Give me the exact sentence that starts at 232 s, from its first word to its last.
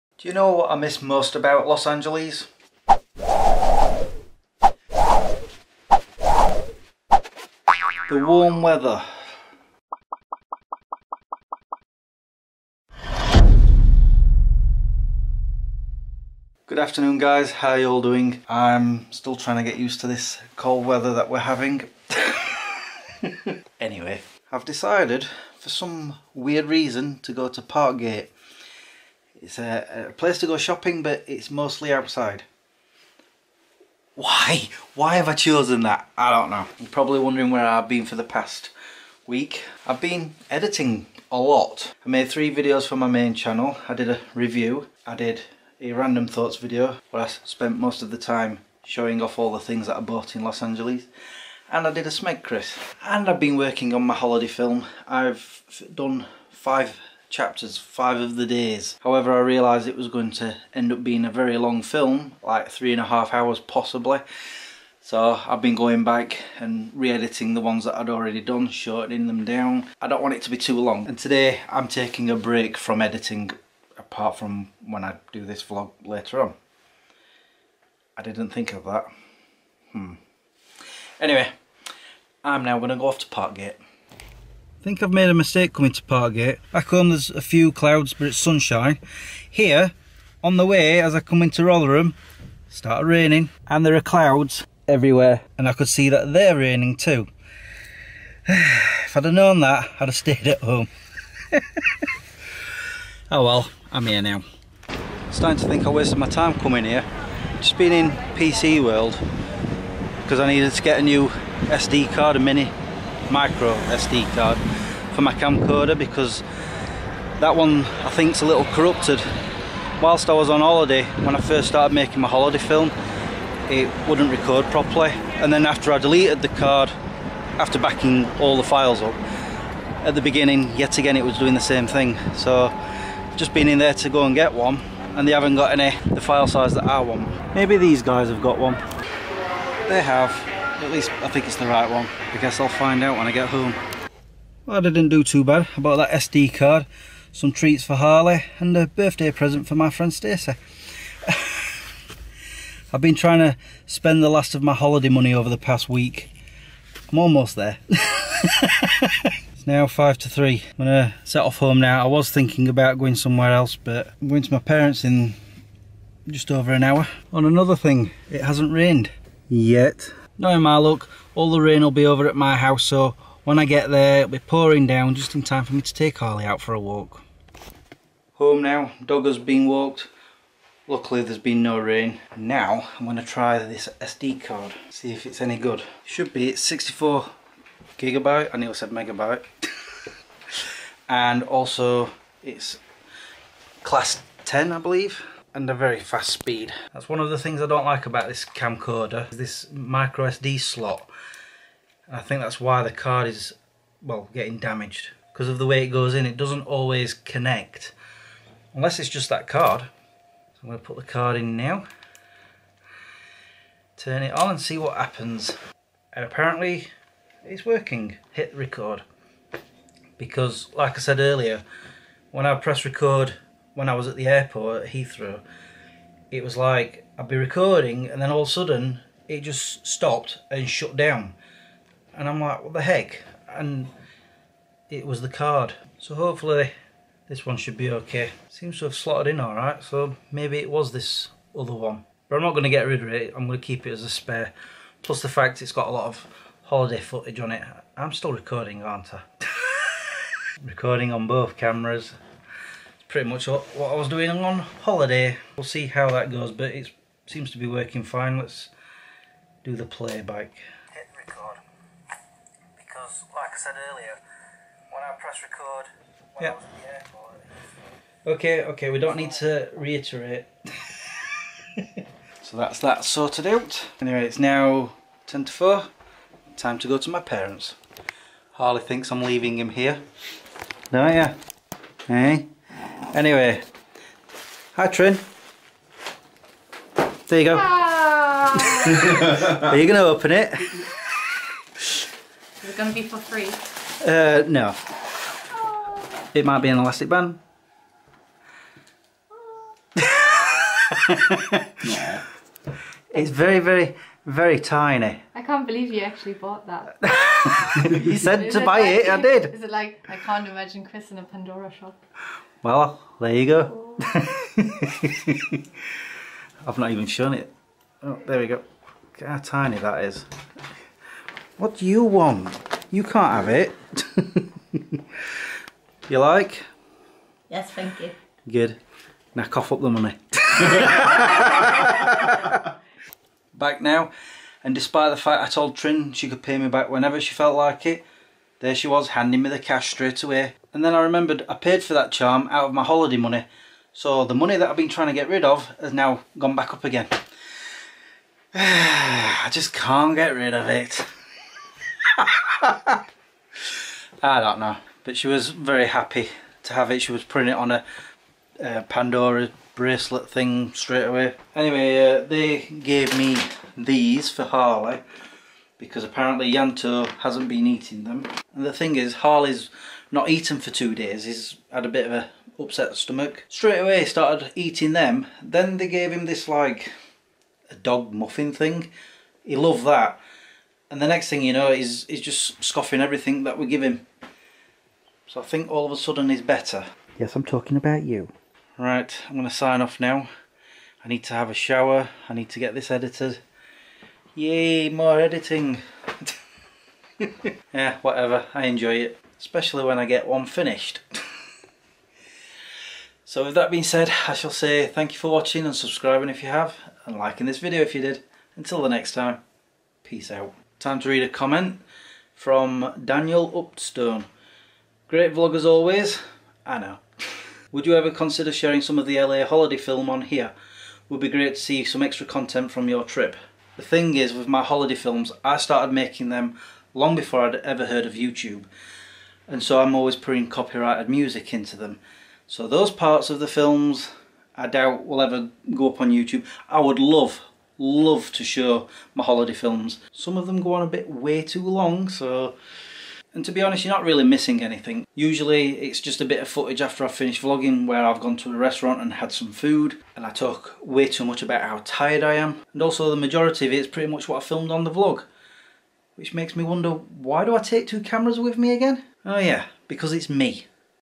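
And I'm like, what the heck?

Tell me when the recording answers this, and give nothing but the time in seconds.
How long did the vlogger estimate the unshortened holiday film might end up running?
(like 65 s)
62 s.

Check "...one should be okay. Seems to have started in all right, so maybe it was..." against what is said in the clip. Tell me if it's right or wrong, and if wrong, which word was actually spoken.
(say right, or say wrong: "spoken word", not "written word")
wrong: "slotted", not "started".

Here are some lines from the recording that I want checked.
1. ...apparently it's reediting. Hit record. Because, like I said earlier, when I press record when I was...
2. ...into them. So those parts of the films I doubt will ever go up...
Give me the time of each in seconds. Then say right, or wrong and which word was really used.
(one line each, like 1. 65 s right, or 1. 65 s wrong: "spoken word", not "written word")
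1. 216 s wrong: "working", not "reediting"
2. 431 s right.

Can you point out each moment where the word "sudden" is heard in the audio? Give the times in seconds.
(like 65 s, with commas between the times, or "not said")
228 s, 385 s.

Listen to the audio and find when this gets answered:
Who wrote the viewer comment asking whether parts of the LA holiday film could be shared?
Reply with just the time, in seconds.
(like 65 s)
413 s.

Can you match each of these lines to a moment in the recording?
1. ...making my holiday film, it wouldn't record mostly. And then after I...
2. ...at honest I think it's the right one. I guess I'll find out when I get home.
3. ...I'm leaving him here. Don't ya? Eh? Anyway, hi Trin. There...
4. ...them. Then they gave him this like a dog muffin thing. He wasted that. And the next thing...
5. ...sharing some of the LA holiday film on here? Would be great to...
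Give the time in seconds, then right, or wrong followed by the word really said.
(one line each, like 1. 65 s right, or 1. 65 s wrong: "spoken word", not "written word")
1. 121 s wrong: "properly", not "mostly"
2. 140 s wrong: "least", not "honest"
3. 279 s right
4. 374 s wrong: "loved", not "wasted"
5. 418 s right.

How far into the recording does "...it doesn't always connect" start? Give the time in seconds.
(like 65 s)
206 s.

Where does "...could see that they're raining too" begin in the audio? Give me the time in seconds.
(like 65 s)
95 s.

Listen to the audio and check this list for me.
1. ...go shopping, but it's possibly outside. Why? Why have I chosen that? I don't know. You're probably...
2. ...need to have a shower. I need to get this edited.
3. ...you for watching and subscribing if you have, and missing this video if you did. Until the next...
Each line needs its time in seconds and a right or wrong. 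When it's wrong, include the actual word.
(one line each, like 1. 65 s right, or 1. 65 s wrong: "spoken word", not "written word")
1. 30 s wrong: "mostly", not "possibly"
2. 391 s right
3. 405 s wrong: "liking", not "missing".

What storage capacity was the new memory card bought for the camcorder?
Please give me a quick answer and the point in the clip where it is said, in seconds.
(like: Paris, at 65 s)
64 gigabytes, at 186 s.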